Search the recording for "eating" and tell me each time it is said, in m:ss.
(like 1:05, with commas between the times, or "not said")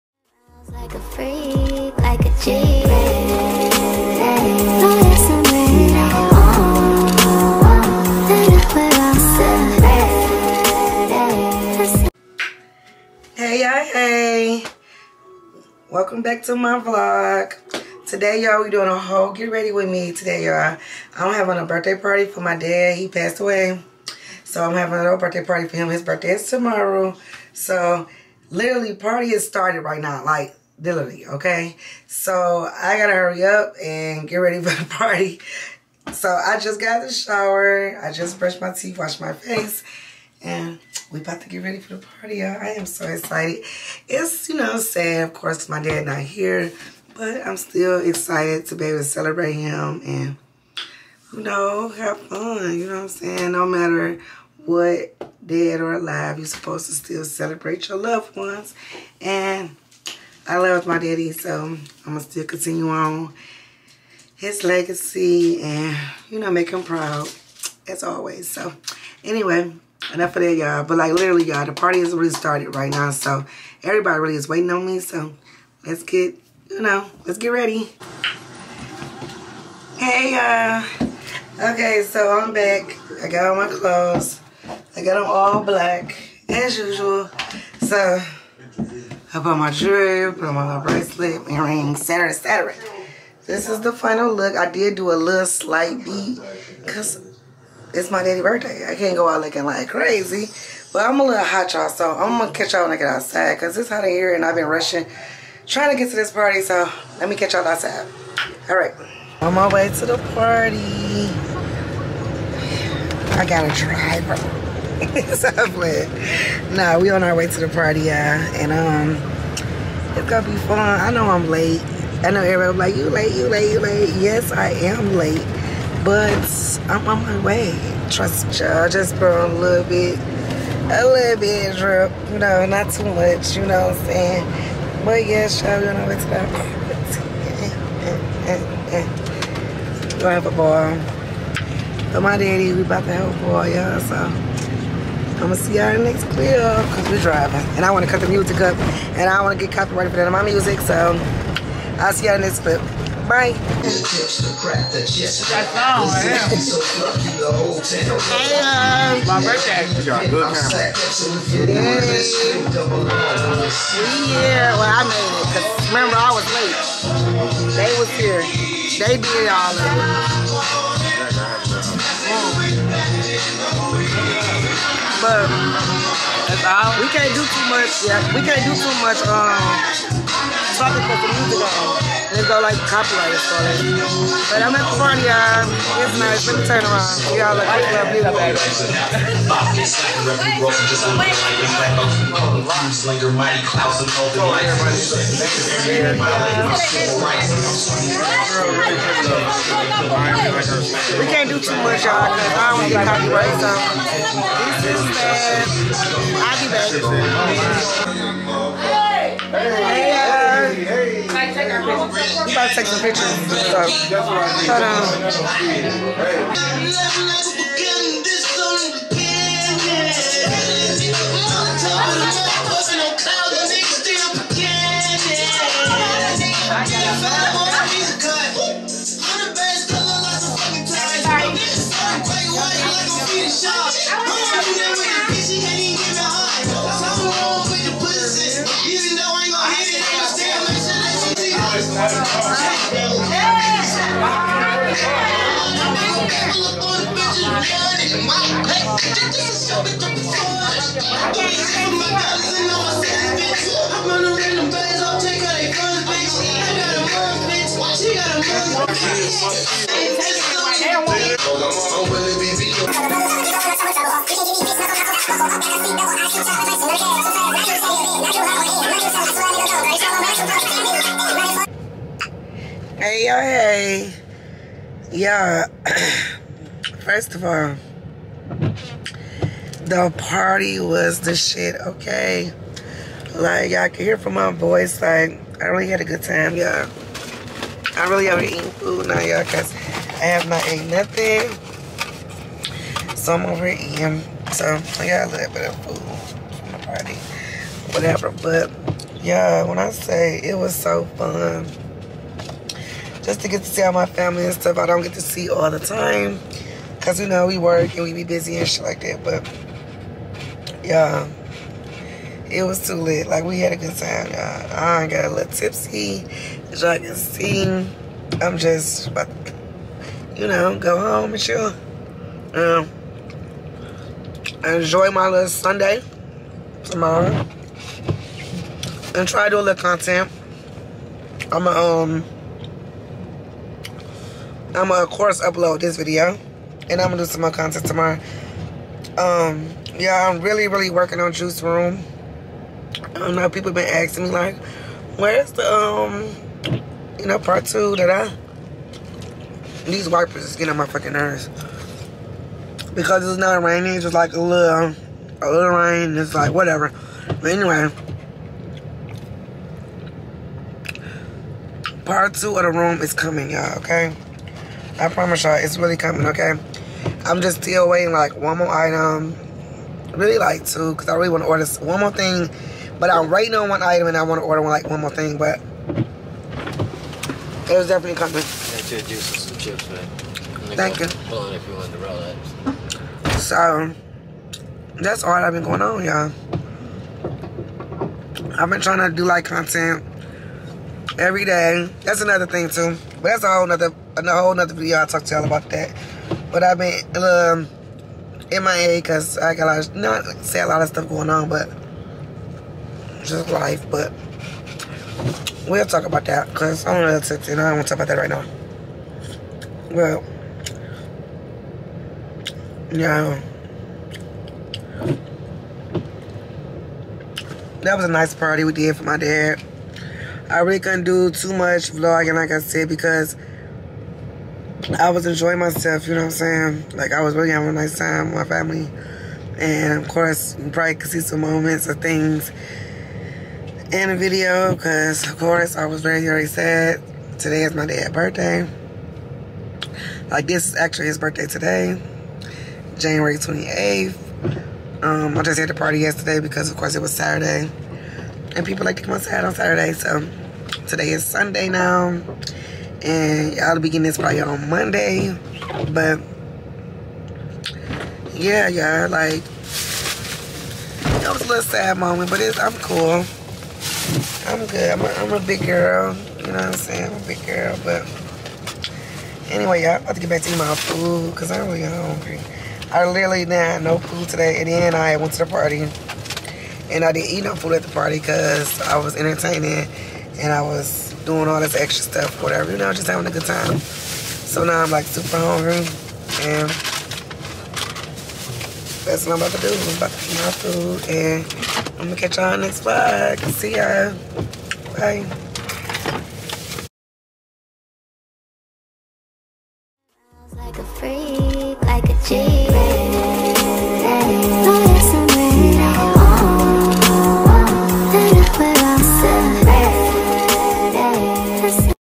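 4:53, 7:50.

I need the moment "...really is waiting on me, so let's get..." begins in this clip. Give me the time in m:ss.
1:14.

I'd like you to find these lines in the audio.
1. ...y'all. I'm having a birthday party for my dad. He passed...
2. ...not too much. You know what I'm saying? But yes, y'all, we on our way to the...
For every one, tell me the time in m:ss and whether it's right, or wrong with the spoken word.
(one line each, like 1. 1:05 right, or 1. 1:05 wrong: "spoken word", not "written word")
1. 0:20 right
2. 2:12 right.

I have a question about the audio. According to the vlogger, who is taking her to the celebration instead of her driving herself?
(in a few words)
A driver.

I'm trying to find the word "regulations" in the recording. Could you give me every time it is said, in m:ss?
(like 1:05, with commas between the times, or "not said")
not said.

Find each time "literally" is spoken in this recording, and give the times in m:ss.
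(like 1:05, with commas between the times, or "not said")
0:28, 1:11, 7:53.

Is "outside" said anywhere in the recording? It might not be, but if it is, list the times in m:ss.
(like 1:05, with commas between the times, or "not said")
1:43, 1:47, 7:29.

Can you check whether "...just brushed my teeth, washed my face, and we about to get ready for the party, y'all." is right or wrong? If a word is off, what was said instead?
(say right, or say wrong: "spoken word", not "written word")
right.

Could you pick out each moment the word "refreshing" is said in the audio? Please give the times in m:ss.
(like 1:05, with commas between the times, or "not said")
not said.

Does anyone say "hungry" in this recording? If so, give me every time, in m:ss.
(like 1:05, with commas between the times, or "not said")
7:51, 8:05.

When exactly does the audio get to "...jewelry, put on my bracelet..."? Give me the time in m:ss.
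1:29.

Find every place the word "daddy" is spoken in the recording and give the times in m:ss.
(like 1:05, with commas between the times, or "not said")
1:00, 1:38, 2:22.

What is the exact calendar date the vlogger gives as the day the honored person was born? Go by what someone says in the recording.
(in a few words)
January 28th.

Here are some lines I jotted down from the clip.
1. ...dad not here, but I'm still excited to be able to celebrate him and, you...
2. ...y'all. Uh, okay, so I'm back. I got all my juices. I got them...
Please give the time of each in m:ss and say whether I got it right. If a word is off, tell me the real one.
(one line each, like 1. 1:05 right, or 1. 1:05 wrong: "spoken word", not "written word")
1. 0:45 right
2. 1:20 wrong: "clothes", not "juices".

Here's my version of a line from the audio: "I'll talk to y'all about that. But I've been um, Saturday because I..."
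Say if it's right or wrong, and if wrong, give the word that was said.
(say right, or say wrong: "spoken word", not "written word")
wrong: "MIA", not "Saturday".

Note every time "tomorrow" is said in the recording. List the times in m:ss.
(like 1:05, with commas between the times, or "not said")
0:26, 5:26, 5:37.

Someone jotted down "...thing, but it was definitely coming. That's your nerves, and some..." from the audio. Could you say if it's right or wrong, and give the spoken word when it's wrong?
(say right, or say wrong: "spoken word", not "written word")
wrong: "juices", not "nerves".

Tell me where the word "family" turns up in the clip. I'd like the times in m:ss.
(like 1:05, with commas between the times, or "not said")
5:04, 7:08.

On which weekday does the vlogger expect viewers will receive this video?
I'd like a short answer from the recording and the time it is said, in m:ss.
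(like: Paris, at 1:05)
Monday, at 7:34.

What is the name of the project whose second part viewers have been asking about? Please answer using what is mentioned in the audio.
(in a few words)
Juice Room.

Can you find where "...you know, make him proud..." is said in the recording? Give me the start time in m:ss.
1:06.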